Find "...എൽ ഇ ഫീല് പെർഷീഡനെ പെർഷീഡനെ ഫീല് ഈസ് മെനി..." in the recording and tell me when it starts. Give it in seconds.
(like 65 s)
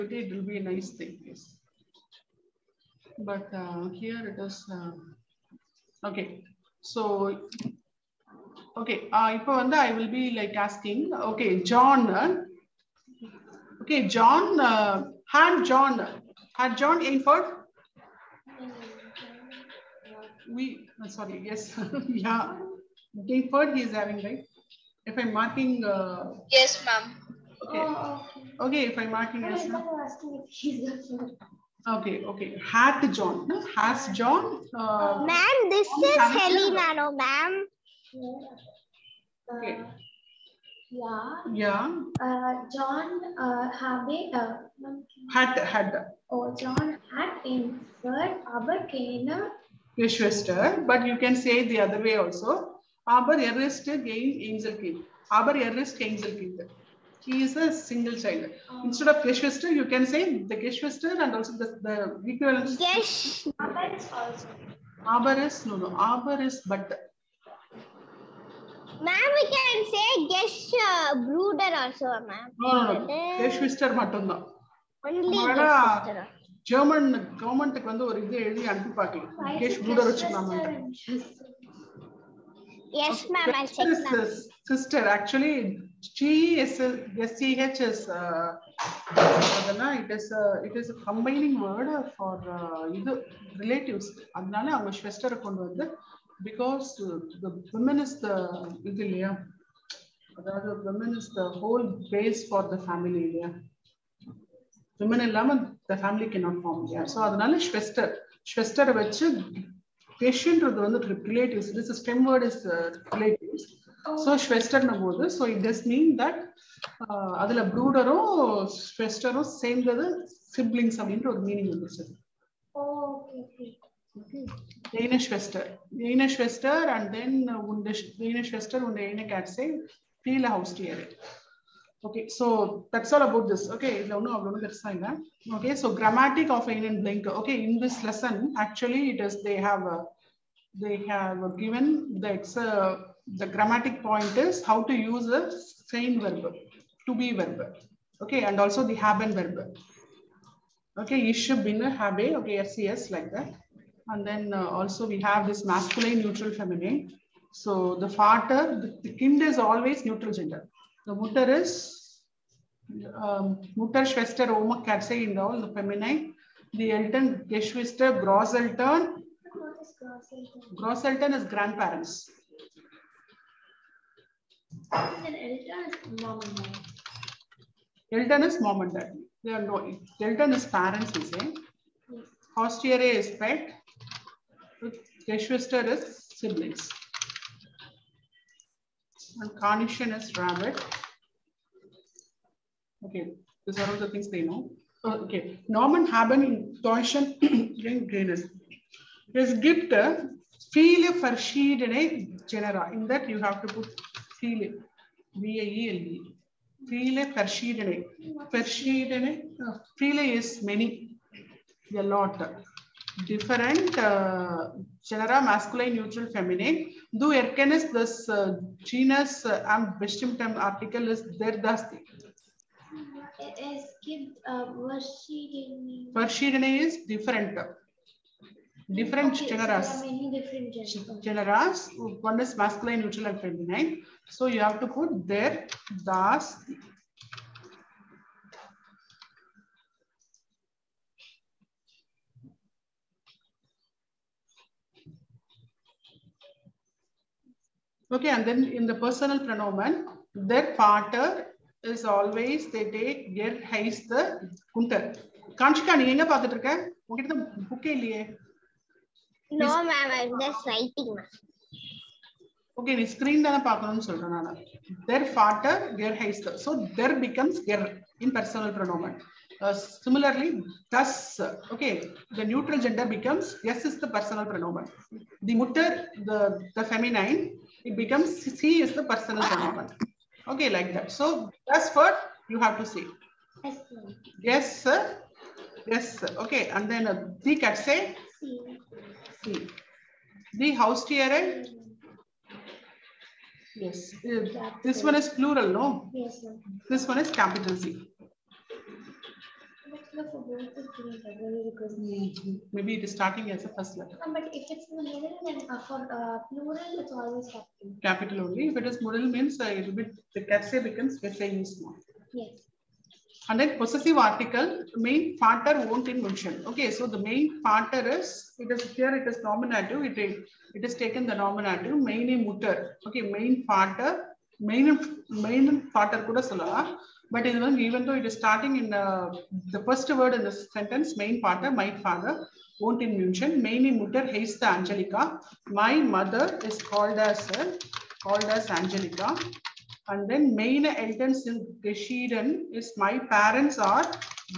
205 s.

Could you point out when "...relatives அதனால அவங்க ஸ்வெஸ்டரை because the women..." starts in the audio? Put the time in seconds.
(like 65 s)
93 s.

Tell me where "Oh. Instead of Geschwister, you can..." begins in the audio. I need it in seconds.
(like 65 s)
58 s.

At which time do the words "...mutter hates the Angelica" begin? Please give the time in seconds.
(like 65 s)
333 s.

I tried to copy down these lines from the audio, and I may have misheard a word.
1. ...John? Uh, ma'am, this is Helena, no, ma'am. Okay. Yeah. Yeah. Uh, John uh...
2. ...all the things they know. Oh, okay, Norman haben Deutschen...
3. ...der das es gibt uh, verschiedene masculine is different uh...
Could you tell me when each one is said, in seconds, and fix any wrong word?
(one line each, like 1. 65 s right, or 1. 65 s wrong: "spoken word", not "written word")
1. 34 s right
2. 193 s right
3. 221 s wrong: "verschiedene", not "masculine".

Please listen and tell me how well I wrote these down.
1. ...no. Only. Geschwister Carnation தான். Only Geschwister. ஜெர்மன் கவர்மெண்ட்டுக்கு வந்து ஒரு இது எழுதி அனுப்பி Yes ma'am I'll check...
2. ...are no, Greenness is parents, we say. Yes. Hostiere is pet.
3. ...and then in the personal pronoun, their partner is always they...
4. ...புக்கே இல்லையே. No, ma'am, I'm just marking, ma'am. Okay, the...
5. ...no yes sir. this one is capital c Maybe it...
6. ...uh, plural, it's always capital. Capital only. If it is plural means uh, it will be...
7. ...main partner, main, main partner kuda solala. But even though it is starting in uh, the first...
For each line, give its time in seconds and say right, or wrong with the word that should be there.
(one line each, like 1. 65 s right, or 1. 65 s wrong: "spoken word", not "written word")
1. 73 s wrong: "German", not "Carnation"
2. 179 s wrong: "Elton", not "Greenness"
3. 248 s right
4. 257 s wrong: "writing", not "marking"
5. 295 s right
6. 306 s right
7. 323 s right.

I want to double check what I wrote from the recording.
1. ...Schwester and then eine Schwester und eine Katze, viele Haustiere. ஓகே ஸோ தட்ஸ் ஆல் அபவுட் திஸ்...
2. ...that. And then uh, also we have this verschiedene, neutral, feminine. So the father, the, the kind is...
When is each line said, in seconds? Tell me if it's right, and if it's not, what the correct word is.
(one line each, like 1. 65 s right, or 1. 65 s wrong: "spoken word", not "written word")
1. 126 s right
2. 153 s wrong: "masculine", not "verschiedene".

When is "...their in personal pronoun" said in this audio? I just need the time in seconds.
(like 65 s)
267 s.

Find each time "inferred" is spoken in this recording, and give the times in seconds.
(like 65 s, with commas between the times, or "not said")
17 s, 23 s, 48 s.